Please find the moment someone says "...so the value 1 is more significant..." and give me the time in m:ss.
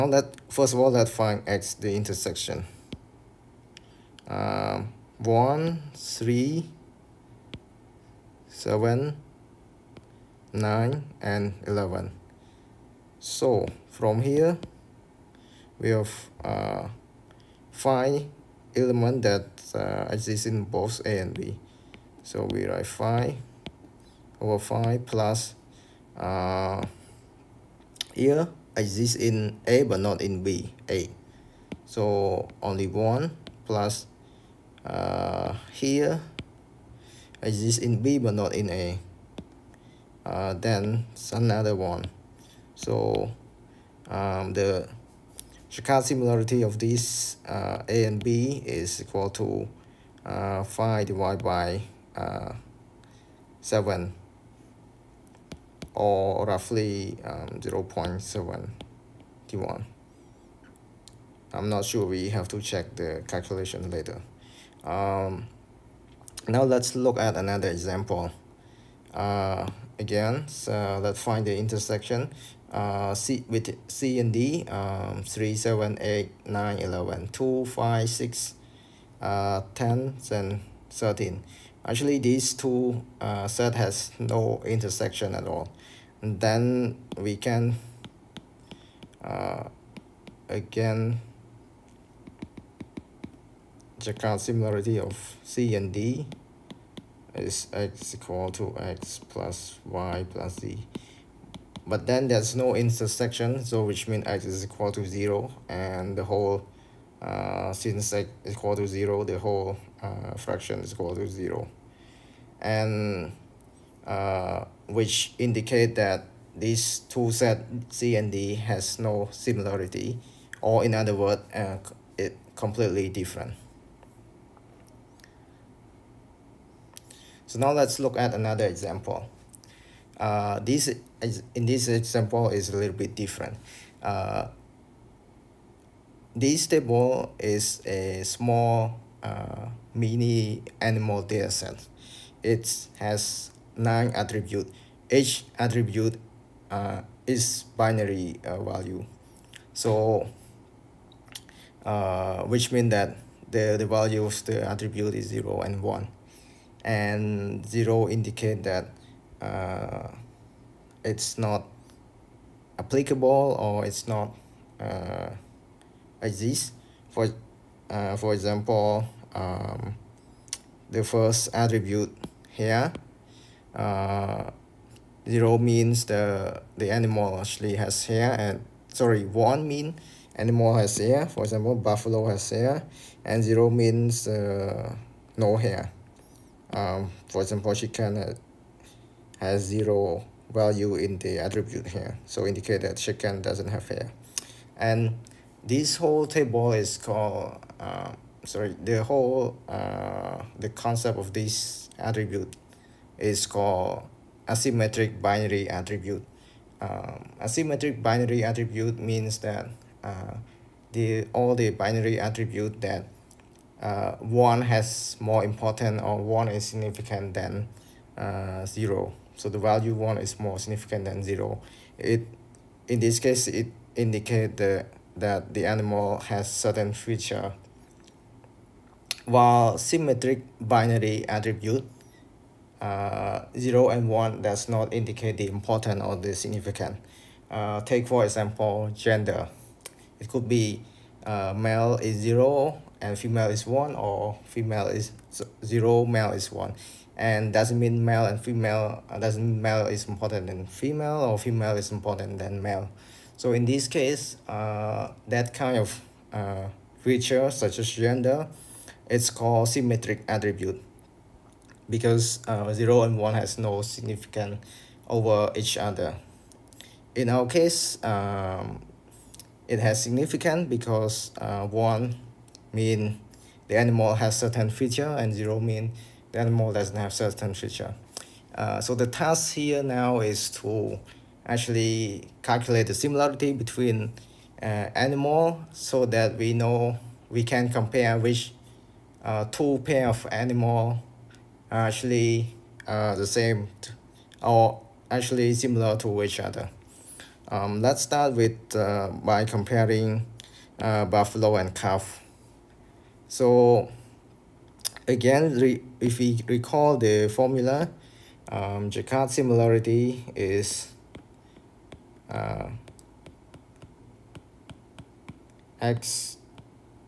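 3:39.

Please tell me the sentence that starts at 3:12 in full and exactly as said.
So indicate that chicken doesn't have hair.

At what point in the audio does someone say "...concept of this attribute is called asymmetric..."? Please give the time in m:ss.
3:20.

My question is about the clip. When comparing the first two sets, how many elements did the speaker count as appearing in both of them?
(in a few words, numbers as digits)
5.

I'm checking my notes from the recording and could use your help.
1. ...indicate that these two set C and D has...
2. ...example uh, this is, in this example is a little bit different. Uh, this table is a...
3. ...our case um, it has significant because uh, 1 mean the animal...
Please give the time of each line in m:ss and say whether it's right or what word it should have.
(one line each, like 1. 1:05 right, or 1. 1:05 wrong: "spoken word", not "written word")
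1. 1:55 right
2. 2:08 right
3. 4:27 right.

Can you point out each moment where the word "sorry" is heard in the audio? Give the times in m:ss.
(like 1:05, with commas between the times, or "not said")
2:58, 3:18.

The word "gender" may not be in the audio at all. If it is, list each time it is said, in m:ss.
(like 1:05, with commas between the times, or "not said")
3:58, 4:17.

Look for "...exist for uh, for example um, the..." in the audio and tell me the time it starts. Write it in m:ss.
2:46.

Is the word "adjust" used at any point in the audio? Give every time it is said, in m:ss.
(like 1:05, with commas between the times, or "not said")
not said.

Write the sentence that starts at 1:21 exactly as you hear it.
Actually, these two uh, set has no intersection at all.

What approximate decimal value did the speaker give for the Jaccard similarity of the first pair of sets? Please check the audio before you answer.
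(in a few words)
0.71.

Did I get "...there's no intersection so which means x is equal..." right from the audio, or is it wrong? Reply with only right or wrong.
right.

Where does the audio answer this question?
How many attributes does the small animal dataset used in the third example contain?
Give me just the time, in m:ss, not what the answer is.
2:23.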